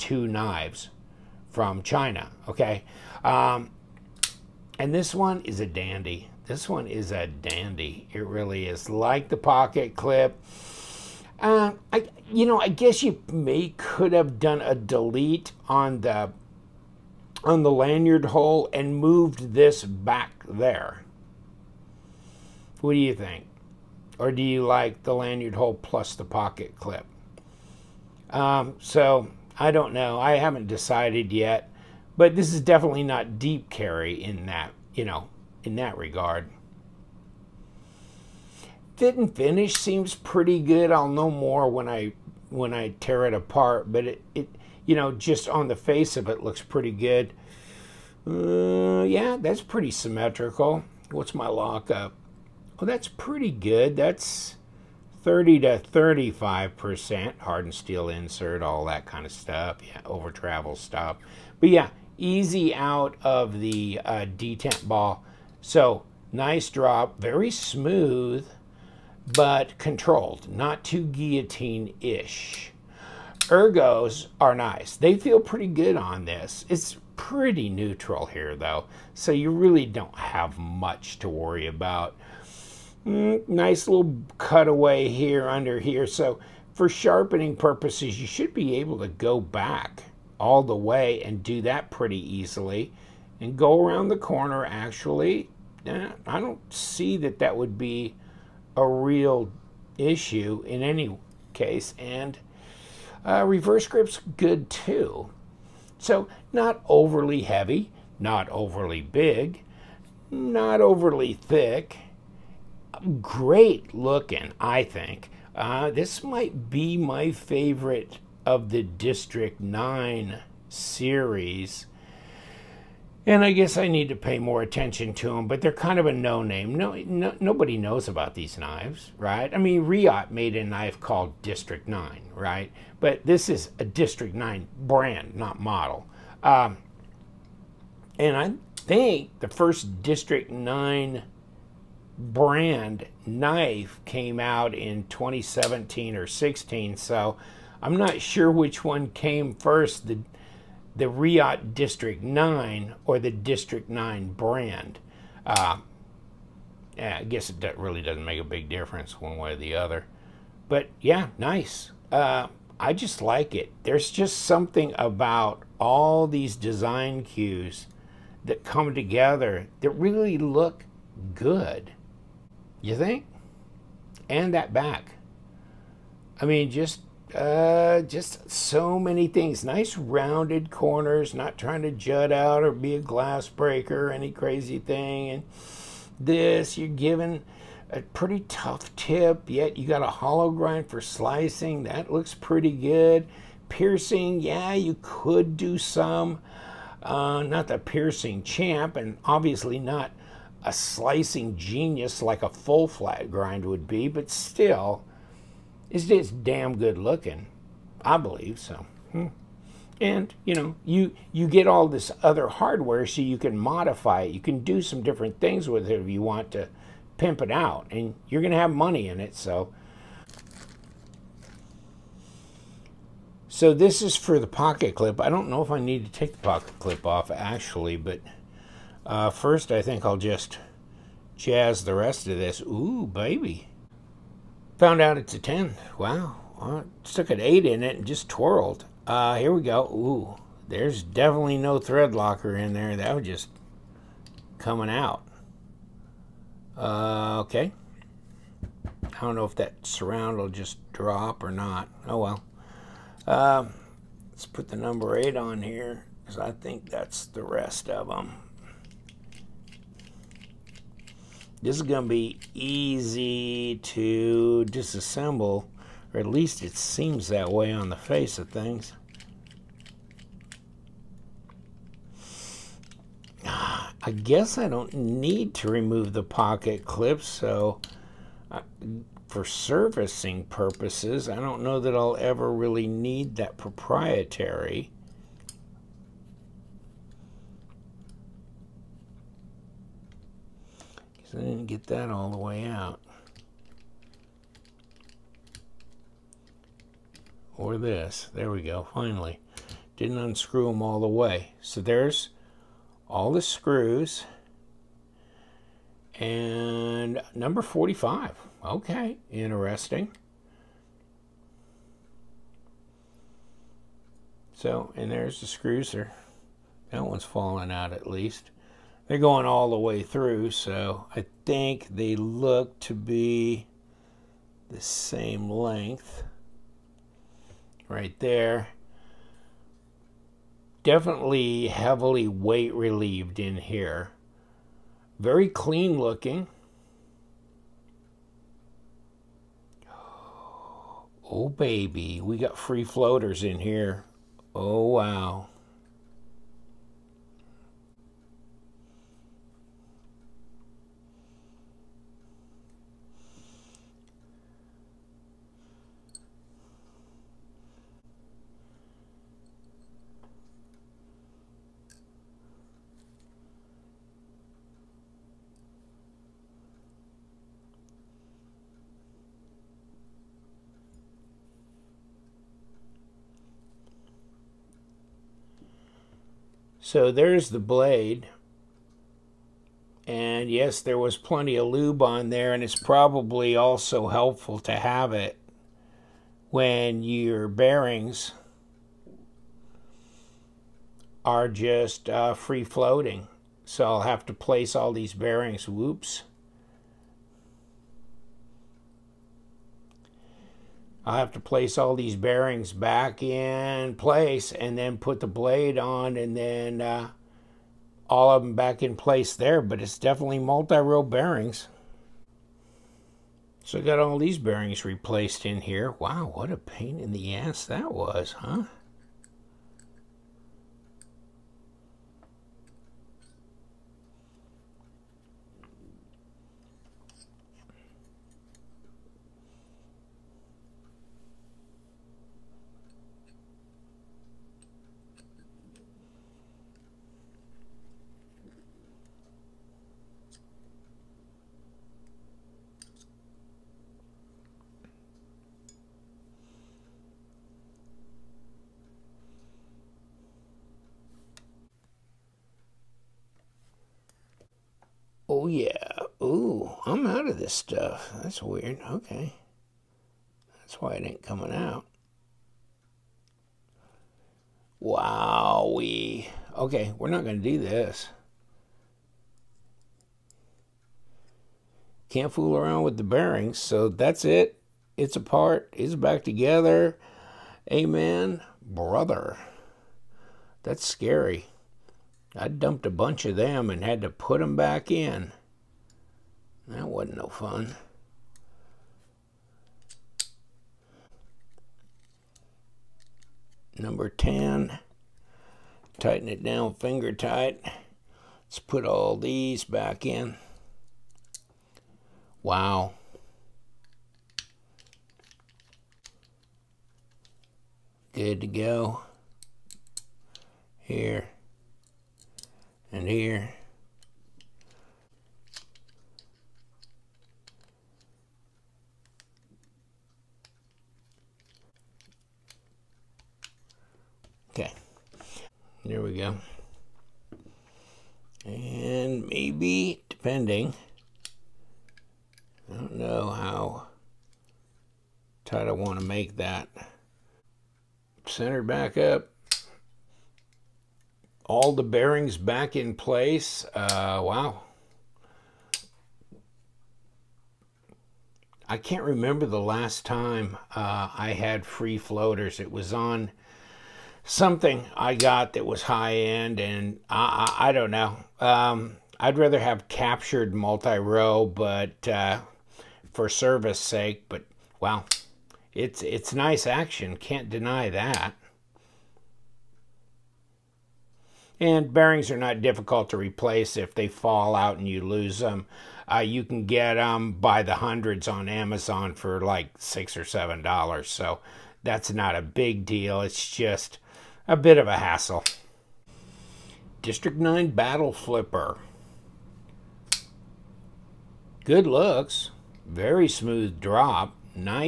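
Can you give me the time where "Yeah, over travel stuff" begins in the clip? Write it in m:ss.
0:59.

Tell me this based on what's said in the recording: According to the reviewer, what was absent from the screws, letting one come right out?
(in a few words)
thread locker.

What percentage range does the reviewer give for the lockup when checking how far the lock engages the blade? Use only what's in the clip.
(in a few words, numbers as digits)
30 to 35%.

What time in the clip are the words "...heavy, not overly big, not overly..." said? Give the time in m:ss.
1:47.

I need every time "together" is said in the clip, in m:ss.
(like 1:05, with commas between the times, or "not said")
2:48, 7:56.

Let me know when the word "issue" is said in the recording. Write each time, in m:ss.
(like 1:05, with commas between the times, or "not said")
1:39.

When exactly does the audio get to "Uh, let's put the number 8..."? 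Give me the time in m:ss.
4:13.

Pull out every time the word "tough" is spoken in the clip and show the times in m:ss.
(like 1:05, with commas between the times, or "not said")
3:08.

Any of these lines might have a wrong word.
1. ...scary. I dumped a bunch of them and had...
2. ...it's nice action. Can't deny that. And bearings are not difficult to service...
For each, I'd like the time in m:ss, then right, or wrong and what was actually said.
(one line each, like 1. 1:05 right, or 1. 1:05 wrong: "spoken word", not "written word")
1. 8:00 right
2. 9:26 wrong: "replace", not "service".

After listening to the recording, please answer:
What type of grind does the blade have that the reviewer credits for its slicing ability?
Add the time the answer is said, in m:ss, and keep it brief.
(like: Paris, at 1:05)
hollow grind, at 3:10.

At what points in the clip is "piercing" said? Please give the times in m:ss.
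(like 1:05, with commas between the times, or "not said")
3:13, 3:17.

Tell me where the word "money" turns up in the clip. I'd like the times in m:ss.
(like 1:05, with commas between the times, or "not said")
3:38.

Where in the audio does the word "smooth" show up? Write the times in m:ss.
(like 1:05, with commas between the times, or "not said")
1:07, 9:53.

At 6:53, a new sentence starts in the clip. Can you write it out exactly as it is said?
So I got all these bearings replaced in here.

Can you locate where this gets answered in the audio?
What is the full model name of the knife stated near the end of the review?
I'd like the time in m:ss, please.
9:47.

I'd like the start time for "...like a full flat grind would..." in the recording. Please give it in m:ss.
3:22.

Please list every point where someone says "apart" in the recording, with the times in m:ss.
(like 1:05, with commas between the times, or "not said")
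0:43, 7:55.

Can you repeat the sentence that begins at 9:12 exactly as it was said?
It was on something I got that was high end, and I, I, I don't know.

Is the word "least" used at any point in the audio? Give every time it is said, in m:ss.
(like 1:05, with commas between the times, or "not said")
4:26, 5:18.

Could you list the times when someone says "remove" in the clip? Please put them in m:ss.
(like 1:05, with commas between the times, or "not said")
4:35.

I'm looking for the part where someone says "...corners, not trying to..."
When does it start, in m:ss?
3:00.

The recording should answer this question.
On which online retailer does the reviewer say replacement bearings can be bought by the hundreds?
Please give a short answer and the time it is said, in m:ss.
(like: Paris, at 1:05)
Amazon, at 9:38.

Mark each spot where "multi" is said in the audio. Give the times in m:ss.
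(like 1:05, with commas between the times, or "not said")
6:50, 9:20.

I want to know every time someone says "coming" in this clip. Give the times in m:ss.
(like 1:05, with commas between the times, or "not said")
4:04, 7:41.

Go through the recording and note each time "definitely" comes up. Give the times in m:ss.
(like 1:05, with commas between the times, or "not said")
0:32, 4:01, 5:30, 6:49.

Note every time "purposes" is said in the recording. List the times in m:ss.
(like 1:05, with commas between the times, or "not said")
1:27, 4:40.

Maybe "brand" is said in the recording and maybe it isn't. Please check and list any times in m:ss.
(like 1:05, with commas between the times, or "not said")
2:14, 2:22, 2:34.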